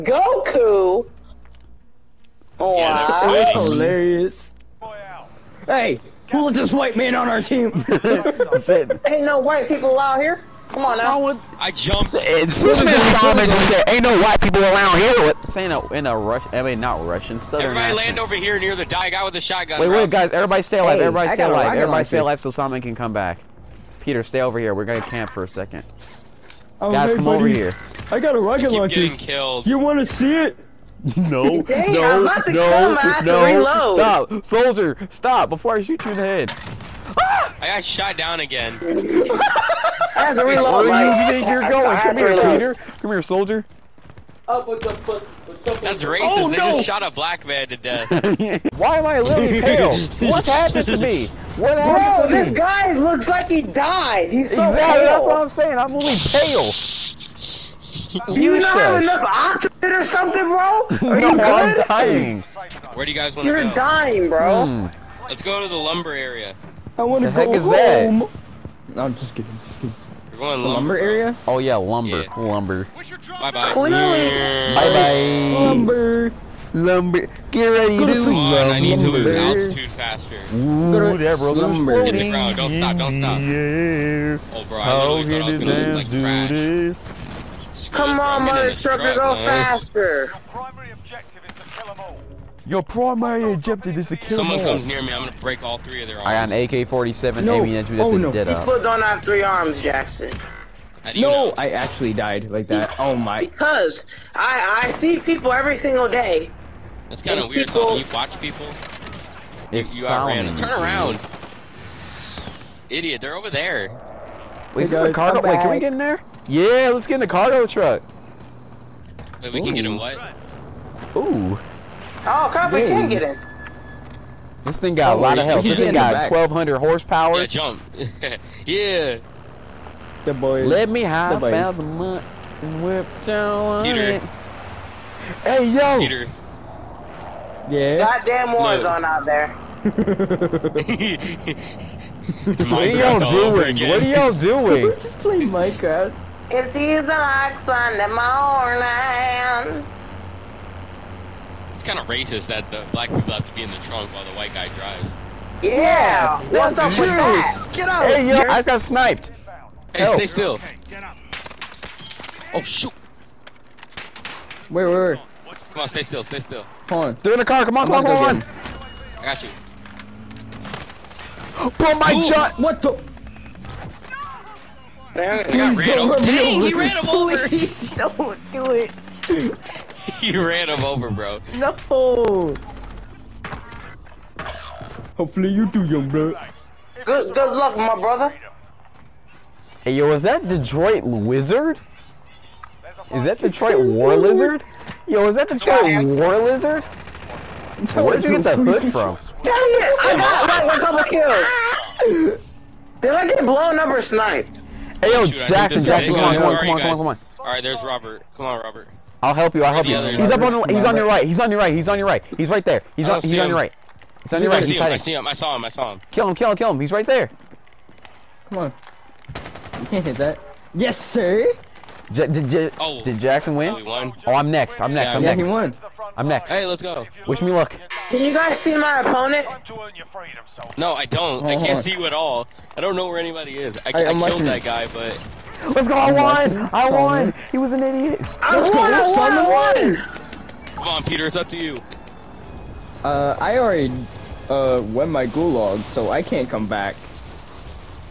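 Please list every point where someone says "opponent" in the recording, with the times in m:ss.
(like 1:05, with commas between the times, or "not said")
3:49.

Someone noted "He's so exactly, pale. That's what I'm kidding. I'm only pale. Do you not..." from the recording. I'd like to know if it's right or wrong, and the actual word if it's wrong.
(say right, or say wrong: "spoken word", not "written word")
wrong: "saying", not "kidding".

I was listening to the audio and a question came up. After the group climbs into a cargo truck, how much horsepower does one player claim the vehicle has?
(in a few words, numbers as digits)
1,200.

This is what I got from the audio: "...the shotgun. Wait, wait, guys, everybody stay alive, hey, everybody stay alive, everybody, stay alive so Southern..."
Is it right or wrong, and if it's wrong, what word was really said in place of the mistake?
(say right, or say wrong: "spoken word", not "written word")
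wrong: "Solomon", not "Southern".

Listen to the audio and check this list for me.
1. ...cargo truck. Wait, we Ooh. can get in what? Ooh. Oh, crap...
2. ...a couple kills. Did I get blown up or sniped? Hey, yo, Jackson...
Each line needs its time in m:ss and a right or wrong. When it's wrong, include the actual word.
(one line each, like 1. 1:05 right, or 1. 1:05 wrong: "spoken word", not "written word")
1. 1:57 right
2. 3:20 right.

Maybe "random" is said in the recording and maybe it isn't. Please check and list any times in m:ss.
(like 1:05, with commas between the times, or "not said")
1:50.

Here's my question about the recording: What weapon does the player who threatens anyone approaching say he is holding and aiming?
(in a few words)
AK-47.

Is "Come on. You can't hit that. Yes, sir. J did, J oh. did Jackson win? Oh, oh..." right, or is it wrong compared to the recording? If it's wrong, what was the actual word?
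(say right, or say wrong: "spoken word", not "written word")
right.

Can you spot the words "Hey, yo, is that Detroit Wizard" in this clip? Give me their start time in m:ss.
3:09.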